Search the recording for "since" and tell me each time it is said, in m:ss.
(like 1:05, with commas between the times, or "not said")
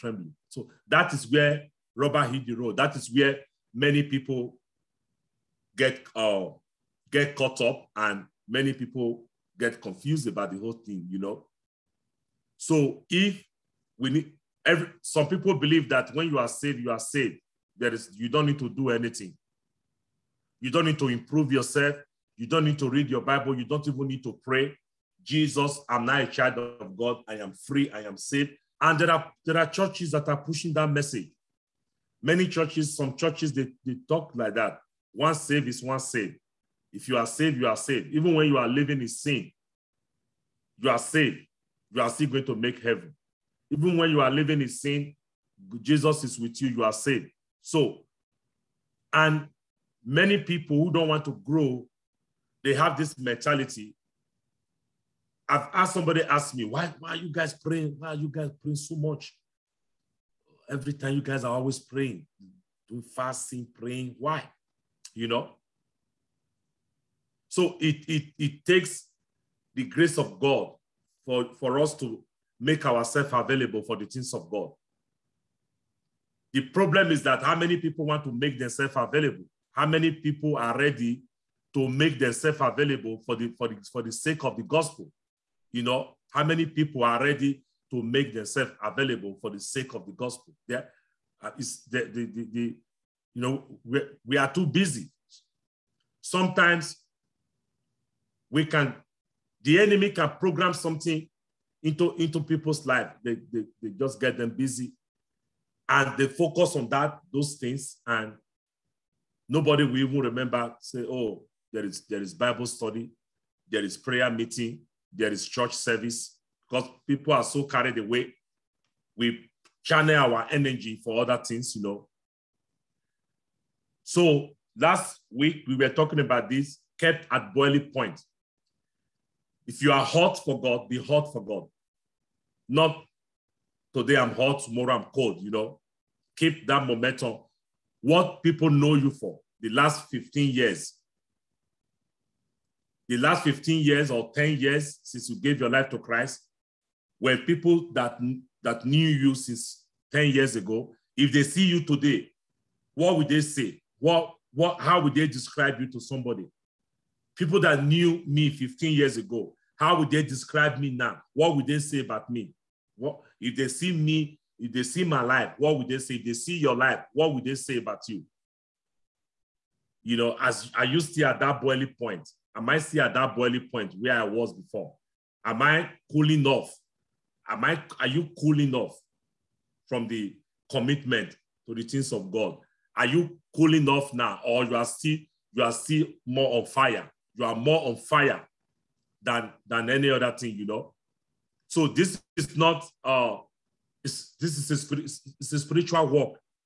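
2:25, 2:29.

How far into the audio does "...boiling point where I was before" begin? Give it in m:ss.
2:53.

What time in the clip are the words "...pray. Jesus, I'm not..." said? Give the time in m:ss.
0:24.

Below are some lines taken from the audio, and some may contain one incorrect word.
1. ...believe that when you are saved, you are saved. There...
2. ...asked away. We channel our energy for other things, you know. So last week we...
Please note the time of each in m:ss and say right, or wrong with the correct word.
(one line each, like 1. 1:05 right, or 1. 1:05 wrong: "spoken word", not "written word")
1. 0:15 right
2. 1:57 wrong: "carried", not "asked".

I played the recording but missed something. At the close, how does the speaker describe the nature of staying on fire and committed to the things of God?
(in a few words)
A spiritual work.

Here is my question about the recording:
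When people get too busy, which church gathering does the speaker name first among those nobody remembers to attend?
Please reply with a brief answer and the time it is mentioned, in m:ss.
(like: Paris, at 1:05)
Bible study, at 1:52.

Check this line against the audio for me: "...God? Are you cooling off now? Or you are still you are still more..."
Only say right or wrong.
right.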